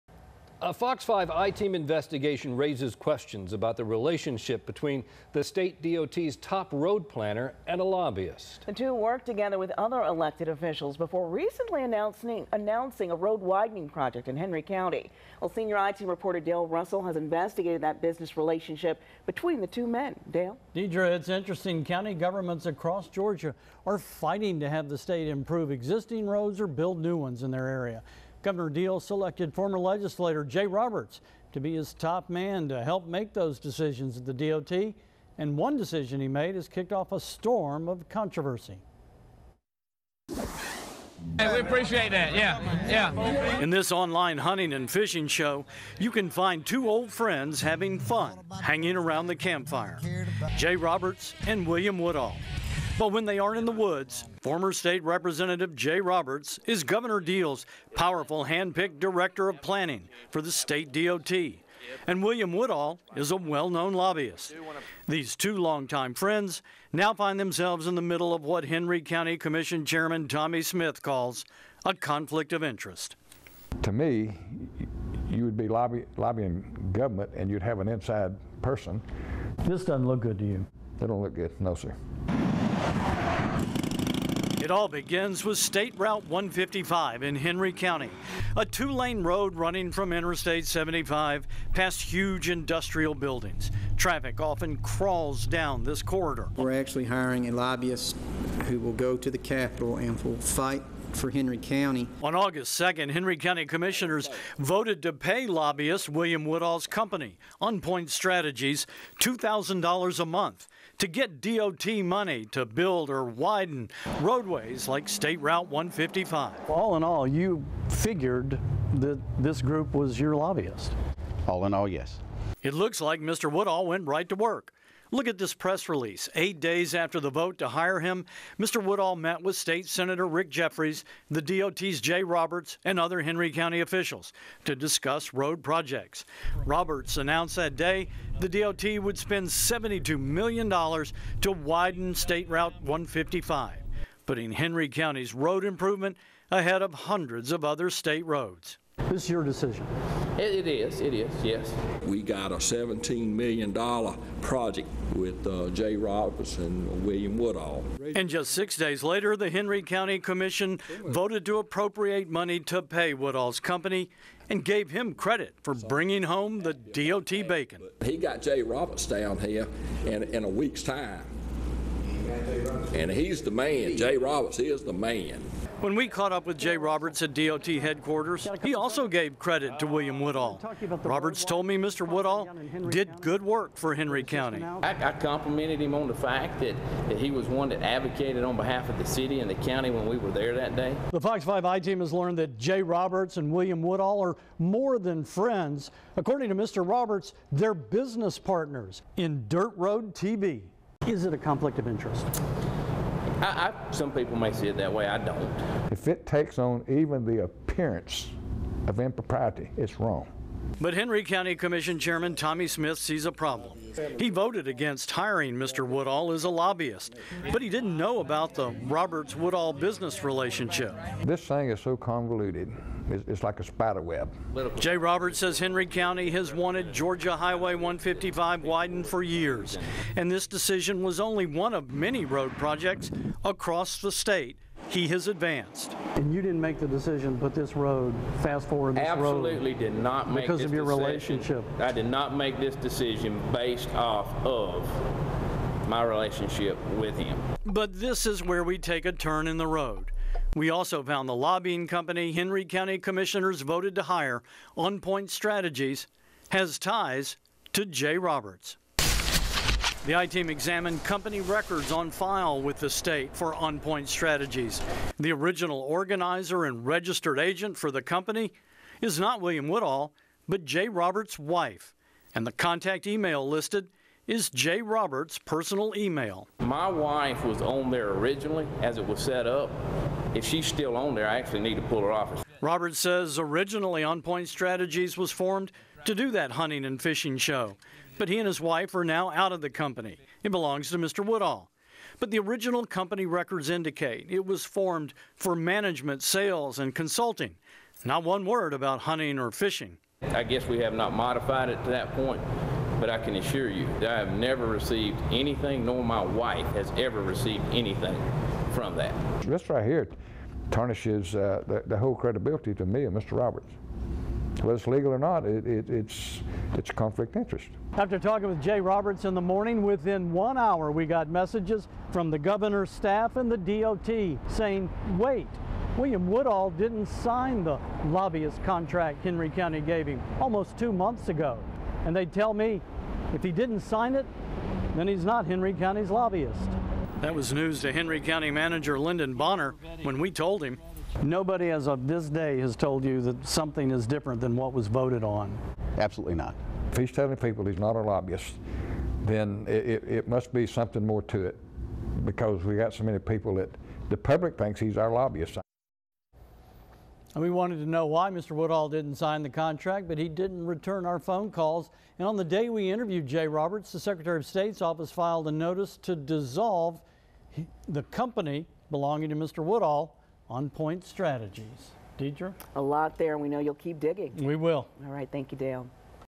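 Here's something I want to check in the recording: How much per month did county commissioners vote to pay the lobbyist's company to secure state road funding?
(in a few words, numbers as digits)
$2,000.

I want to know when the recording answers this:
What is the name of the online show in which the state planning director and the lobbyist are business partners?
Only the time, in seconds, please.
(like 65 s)
199 s.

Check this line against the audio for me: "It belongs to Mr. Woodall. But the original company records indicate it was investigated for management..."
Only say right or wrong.
wrong.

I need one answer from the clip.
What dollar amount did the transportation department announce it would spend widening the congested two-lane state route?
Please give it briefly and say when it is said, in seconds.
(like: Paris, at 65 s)
$72 million, at 139 s.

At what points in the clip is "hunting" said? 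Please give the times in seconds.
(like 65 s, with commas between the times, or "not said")
44 s, 286 s, 298 s.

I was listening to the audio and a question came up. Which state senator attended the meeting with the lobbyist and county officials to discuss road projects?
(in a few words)
Rick Jeffares.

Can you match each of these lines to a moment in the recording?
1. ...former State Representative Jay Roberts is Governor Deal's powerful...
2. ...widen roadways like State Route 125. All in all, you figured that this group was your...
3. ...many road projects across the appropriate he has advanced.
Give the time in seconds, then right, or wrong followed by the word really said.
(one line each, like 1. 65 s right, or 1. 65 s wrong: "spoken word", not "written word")
1. 54 s right
2. 113 s wrong: "155", not "125"
3. 231 s wrong: "state", not "appropriate".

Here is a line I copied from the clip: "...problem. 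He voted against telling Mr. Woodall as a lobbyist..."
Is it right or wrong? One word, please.
wrong.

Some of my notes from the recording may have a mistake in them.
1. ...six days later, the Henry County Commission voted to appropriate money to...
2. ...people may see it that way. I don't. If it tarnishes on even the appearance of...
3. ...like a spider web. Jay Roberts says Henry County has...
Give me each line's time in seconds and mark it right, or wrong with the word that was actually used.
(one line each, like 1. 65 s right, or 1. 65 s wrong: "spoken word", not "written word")
1. 158 s right
2. 204 s wrong: "takes", not "tarnishes"
3. 223 s right.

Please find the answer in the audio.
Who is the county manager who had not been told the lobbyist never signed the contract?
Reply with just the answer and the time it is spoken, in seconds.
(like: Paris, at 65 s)
Lyndon Bonner, at 338 s.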